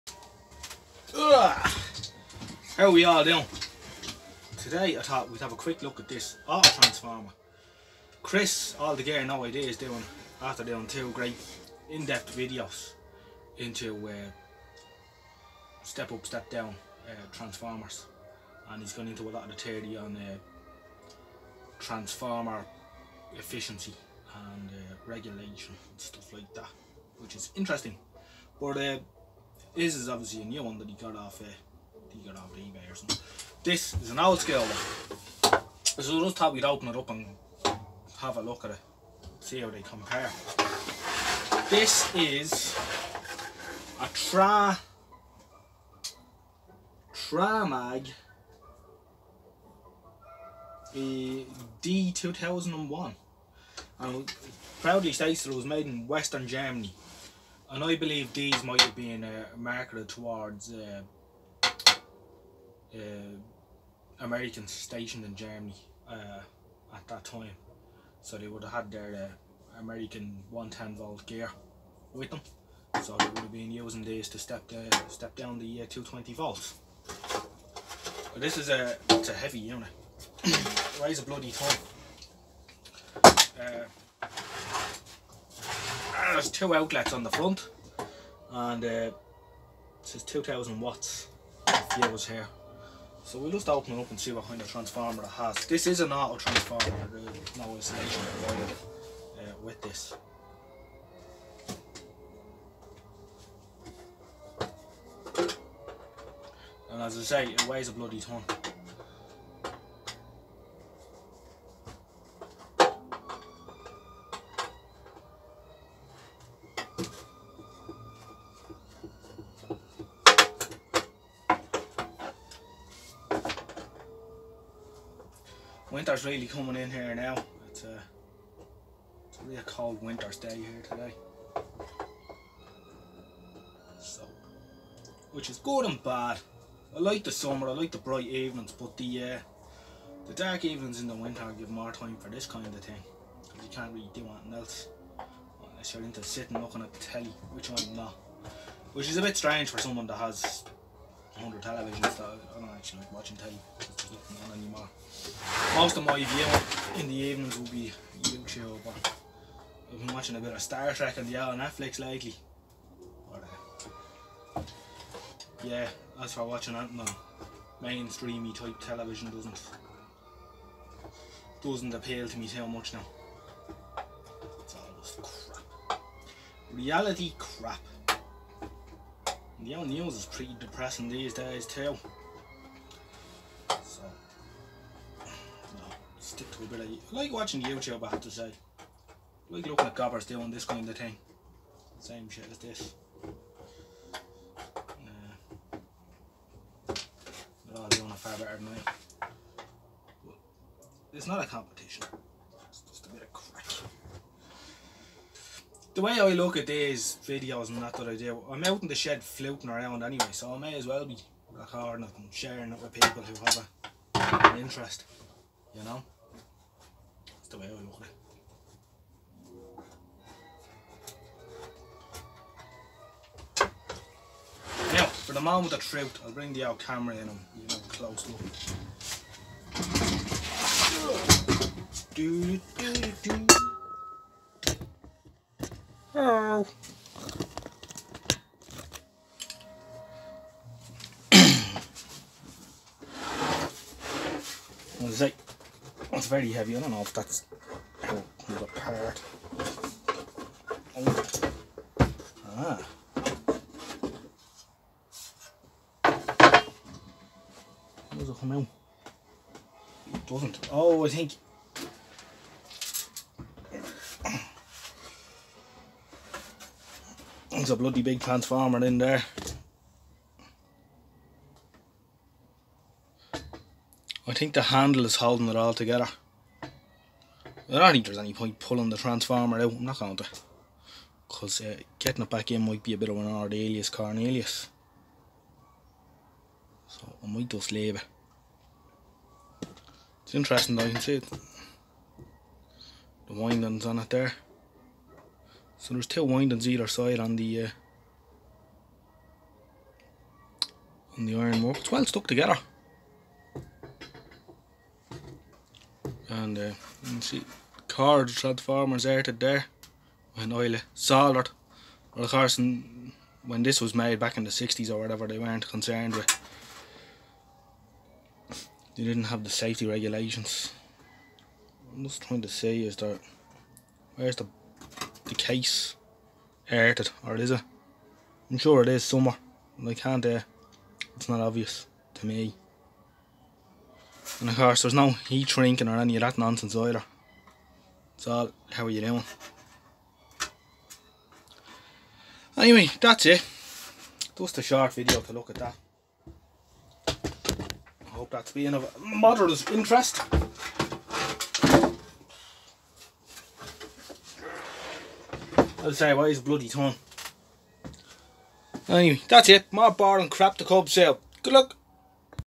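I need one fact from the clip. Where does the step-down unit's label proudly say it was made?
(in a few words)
Western Germany.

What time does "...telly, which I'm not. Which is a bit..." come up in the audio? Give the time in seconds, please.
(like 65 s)
146 s.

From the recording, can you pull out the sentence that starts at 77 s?
But this is a it's a heavy unit.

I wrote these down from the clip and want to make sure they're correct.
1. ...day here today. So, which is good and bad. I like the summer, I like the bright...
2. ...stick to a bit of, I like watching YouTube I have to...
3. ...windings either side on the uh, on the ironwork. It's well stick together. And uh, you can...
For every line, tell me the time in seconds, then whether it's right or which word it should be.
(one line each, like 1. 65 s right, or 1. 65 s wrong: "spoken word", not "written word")
1. 130 s right
2. 186 s right
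3. 296 s wrong: "stuck", not "stick".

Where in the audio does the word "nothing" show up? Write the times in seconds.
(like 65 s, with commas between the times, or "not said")
154 s.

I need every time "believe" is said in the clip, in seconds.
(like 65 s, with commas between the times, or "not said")
57 s.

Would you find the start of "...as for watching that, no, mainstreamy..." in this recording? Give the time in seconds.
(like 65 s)
166 s.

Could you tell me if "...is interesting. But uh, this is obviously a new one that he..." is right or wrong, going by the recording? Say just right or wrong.
right.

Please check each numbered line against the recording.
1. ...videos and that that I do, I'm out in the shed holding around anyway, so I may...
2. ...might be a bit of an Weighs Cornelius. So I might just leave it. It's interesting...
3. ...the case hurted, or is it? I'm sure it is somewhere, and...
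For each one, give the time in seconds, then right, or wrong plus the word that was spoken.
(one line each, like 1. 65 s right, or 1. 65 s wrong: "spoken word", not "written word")
1. 207 s wrong: "floating", not "holding"
2. 282 s wrong: "Ardelius", not "Weighs"
3. 325 s right.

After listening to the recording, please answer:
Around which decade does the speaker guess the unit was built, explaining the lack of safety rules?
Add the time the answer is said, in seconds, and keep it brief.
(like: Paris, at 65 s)
1960s, at 314 s.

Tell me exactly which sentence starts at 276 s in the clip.
I don't think there's any point pulling the transformer out.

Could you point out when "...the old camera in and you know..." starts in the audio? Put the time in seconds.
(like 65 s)
226 s.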